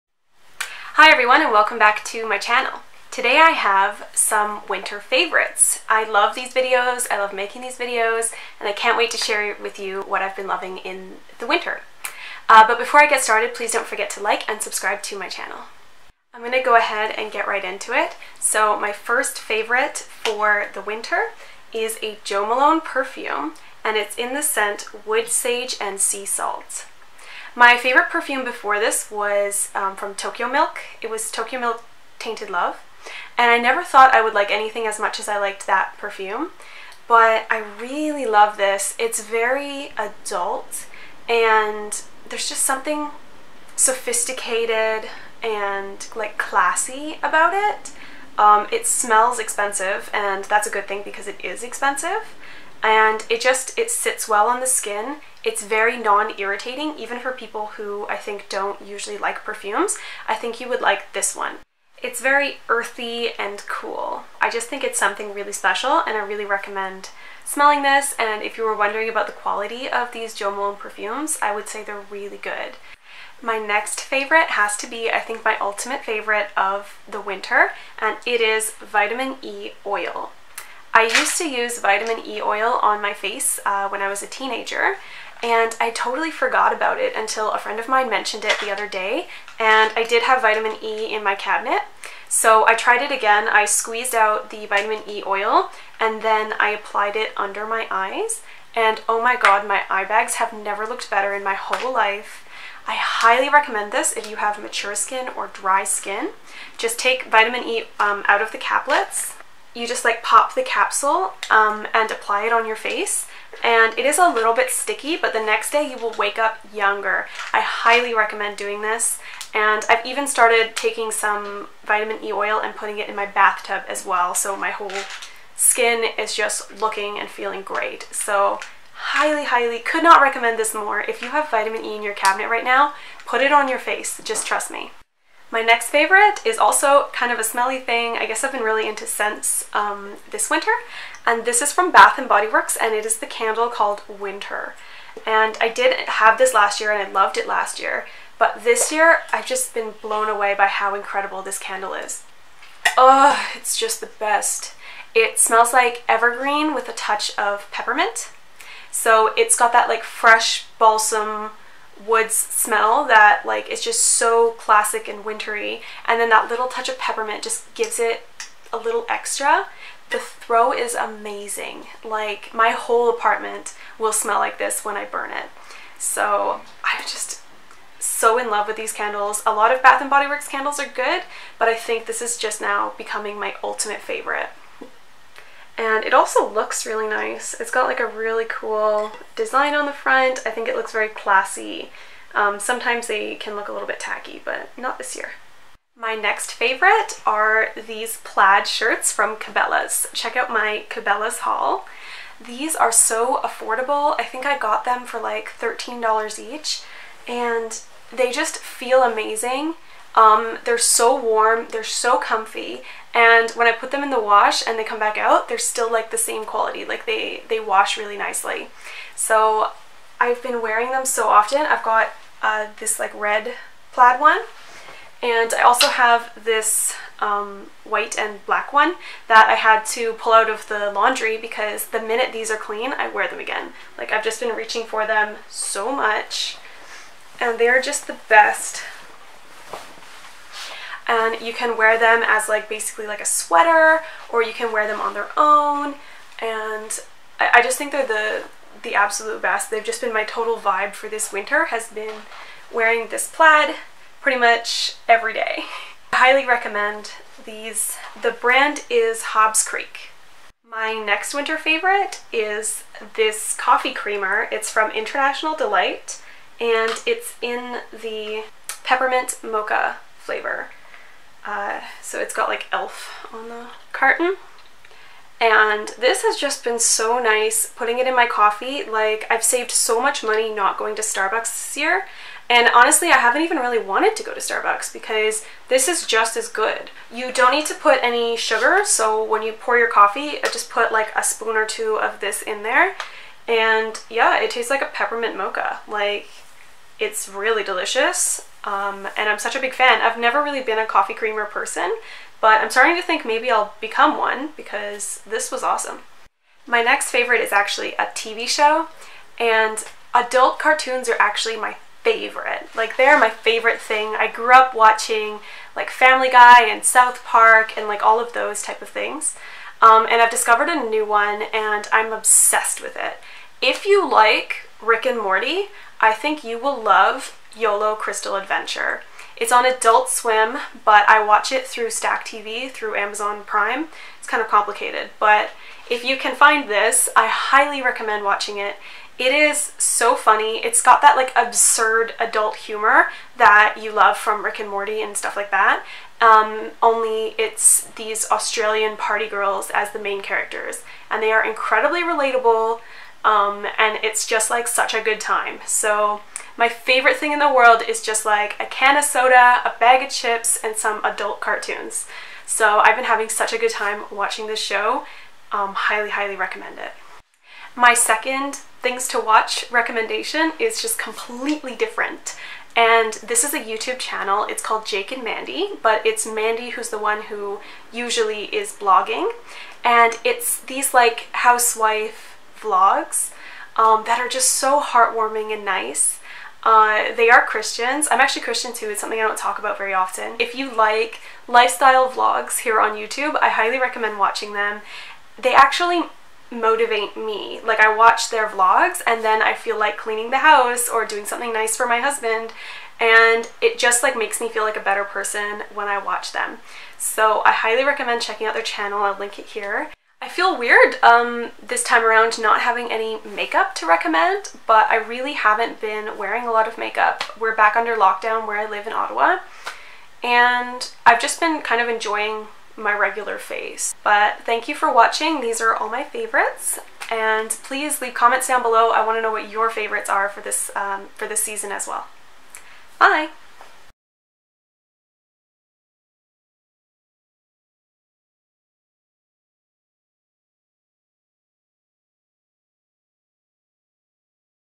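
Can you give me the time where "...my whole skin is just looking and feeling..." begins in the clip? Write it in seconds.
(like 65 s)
124 s.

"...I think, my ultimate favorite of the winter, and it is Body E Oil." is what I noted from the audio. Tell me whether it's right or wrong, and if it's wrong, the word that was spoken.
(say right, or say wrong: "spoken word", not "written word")
wrong: "Vitamin", not "Body".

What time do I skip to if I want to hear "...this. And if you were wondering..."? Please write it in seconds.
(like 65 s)
67 s.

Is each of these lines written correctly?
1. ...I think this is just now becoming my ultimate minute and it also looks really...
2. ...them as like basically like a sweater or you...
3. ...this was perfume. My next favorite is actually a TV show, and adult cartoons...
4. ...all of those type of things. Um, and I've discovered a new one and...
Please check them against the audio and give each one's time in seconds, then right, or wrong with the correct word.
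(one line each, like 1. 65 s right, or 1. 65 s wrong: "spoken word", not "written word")
1. 181 s wrong: "favorite", not "minute"
2. 241 s right
3. 305 s wrong: "awesome", not "perfume"
4. 318 s right.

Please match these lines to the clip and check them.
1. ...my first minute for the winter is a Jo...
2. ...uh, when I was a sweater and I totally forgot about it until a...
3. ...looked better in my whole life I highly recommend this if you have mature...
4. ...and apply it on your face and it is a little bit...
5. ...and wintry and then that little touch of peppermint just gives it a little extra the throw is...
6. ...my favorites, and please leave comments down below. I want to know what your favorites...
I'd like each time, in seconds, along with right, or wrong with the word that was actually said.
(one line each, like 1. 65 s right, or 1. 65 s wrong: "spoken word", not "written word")
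1. 18 s wrong: "favorite", not "minute"
2. 83 s wrong: "teenager", not "sweater"
3. 100 s right
4. 111 s right
5. 165 s right
6. 425 s right.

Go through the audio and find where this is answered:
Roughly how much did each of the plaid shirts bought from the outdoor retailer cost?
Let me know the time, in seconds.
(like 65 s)
205 s.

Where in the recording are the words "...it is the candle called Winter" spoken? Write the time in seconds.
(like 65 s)
142 s.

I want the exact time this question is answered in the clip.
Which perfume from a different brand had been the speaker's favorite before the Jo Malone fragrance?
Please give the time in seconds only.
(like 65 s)
31 s.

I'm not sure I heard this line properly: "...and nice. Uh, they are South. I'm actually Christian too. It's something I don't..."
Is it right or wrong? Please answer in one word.
wrong.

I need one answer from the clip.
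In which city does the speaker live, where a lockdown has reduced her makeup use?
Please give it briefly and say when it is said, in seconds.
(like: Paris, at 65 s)
Ottawa, at 418 s.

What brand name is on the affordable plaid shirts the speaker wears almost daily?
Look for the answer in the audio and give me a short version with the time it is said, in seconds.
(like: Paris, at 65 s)
Hobbs Creek, at 259 s.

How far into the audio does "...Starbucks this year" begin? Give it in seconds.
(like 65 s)
281 s.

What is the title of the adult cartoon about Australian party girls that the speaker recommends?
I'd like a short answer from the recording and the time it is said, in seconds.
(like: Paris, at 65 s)
YOLO Crystal Adventure, at 327 s.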